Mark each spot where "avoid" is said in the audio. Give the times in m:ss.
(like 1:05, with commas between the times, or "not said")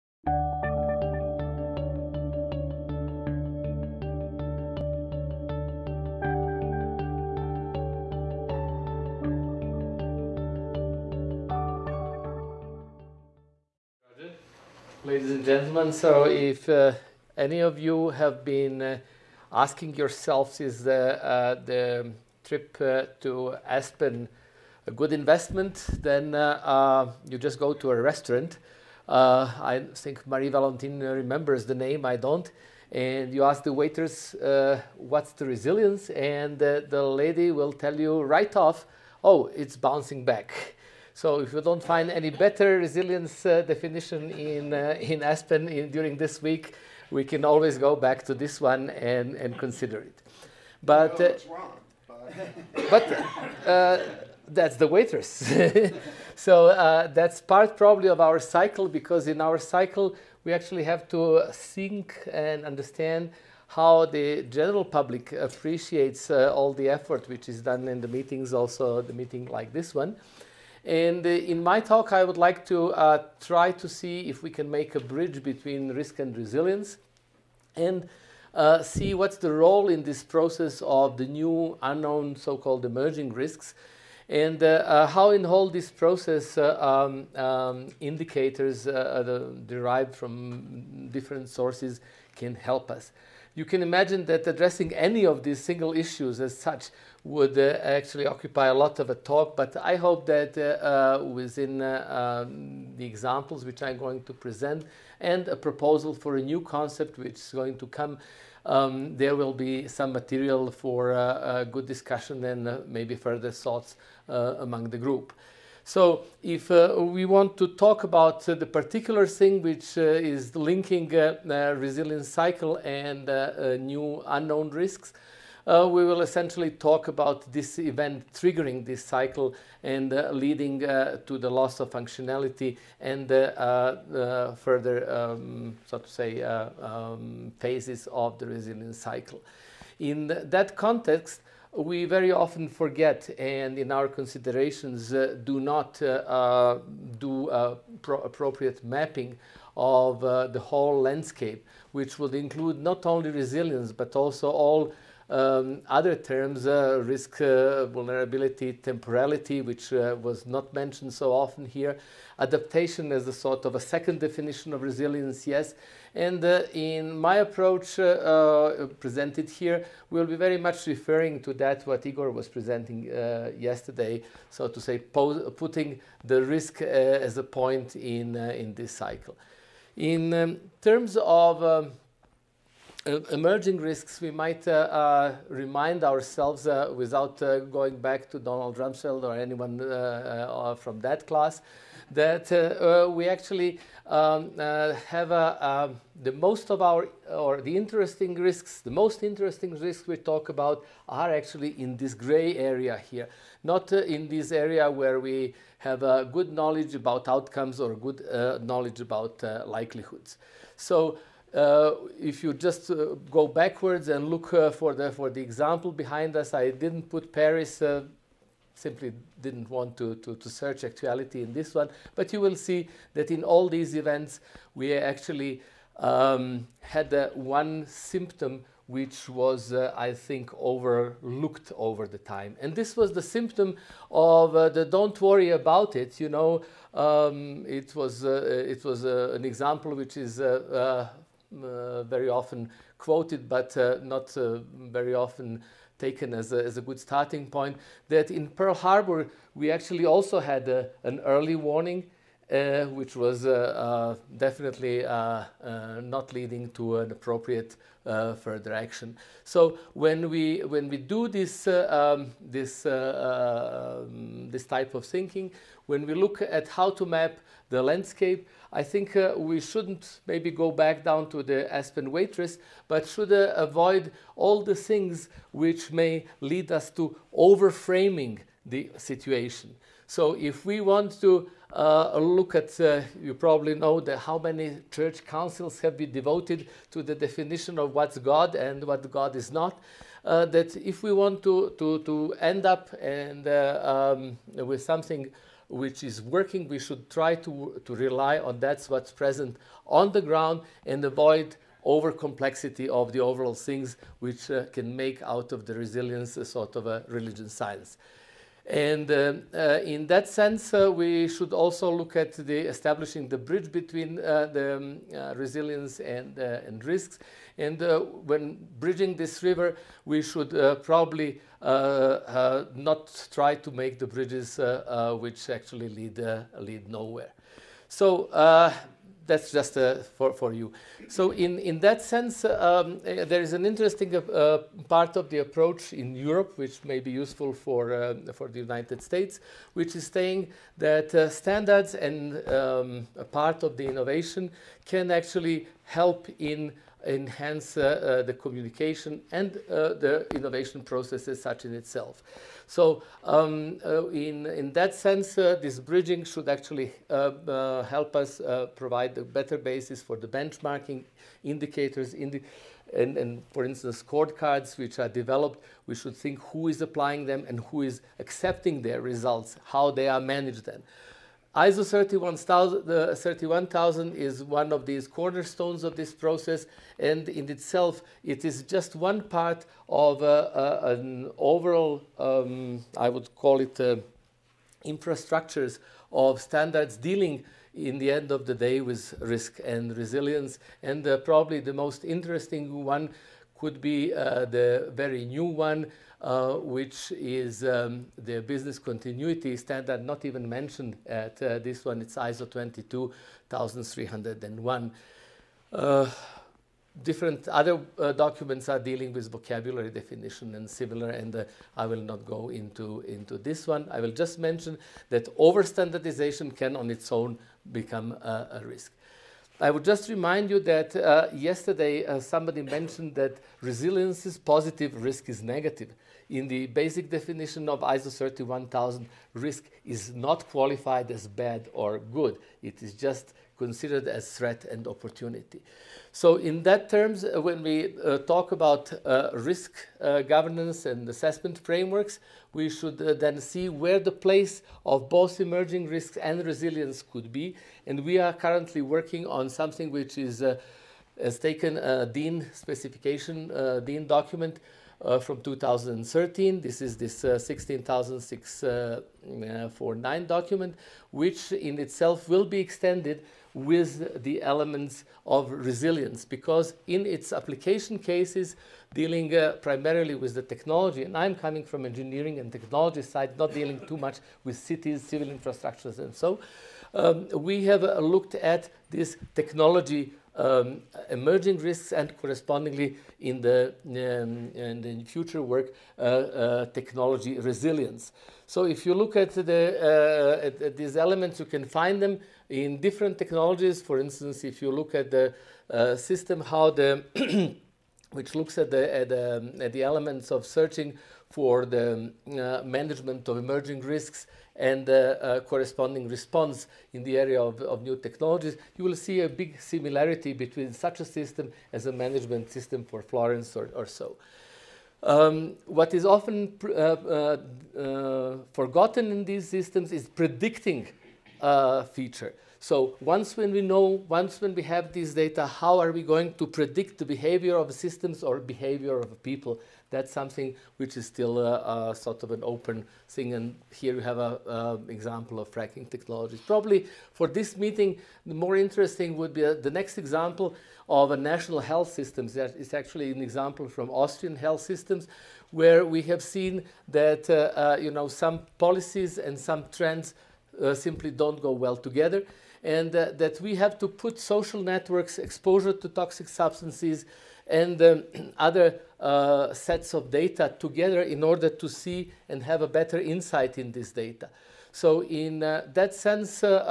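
4:33, 5:01.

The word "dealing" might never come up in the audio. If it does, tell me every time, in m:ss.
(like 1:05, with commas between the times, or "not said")
6:26, 6:48, 7:48, 7:53.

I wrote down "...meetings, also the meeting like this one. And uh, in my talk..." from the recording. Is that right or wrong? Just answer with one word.
right.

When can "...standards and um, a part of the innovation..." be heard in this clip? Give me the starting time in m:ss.
5:41.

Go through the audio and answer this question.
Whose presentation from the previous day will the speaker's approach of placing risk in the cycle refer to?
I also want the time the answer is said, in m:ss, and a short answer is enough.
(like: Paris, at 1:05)
Igor, at 2:52.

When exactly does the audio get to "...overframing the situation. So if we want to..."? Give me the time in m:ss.
4:37.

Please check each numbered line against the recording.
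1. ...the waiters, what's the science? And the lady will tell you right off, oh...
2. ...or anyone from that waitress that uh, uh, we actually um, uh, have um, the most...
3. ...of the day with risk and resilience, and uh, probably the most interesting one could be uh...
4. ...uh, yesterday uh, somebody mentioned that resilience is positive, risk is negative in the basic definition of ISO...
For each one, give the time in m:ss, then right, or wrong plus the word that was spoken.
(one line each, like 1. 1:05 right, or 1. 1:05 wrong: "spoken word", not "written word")
1. 0:33 wrong: "resilience", not "science"
2. 3:09 wrong: "class", not "waitress"
3. 6:28 right
4. 7:00 right.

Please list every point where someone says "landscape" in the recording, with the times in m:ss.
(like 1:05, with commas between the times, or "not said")
2:30, 4:27.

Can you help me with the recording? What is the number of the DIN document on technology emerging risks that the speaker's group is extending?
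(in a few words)
16649.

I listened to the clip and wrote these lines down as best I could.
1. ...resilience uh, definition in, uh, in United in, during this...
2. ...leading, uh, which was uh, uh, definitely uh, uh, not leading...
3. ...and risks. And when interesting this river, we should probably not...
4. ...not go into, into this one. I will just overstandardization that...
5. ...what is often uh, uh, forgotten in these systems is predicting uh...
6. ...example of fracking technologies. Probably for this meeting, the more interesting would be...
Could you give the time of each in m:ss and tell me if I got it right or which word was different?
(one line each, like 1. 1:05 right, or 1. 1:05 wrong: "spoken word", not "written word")
1. 0:42 wrong: "Aspen", not "United"
2. 4:11 wrong: "warning", not "leading"
3. 5:16 wrong: "bridging", not "interesting"
4. 6:52 wrong: "mention", not "overstandardization"
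5. 8:35 right
6. 8:54 right.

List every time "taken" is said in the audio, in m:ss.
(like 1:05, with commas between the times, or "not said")
4:05, 7:31.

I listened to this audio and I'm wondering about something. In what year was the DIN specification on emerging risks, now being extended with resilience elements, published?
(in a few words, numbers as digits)
2013.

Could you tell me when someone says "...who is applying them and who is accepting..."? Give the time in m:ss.
6:06.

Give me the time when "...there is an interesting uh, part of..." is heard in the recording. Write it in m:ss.
5:33.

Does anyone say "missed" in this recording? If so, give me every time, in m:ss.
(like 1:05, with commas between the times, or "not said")
not said.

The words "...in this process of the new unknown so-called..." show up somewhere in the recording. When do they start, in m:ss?
1:19.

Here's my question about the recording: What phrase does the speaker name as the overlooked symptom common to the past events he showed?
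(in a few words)
don't worry about it.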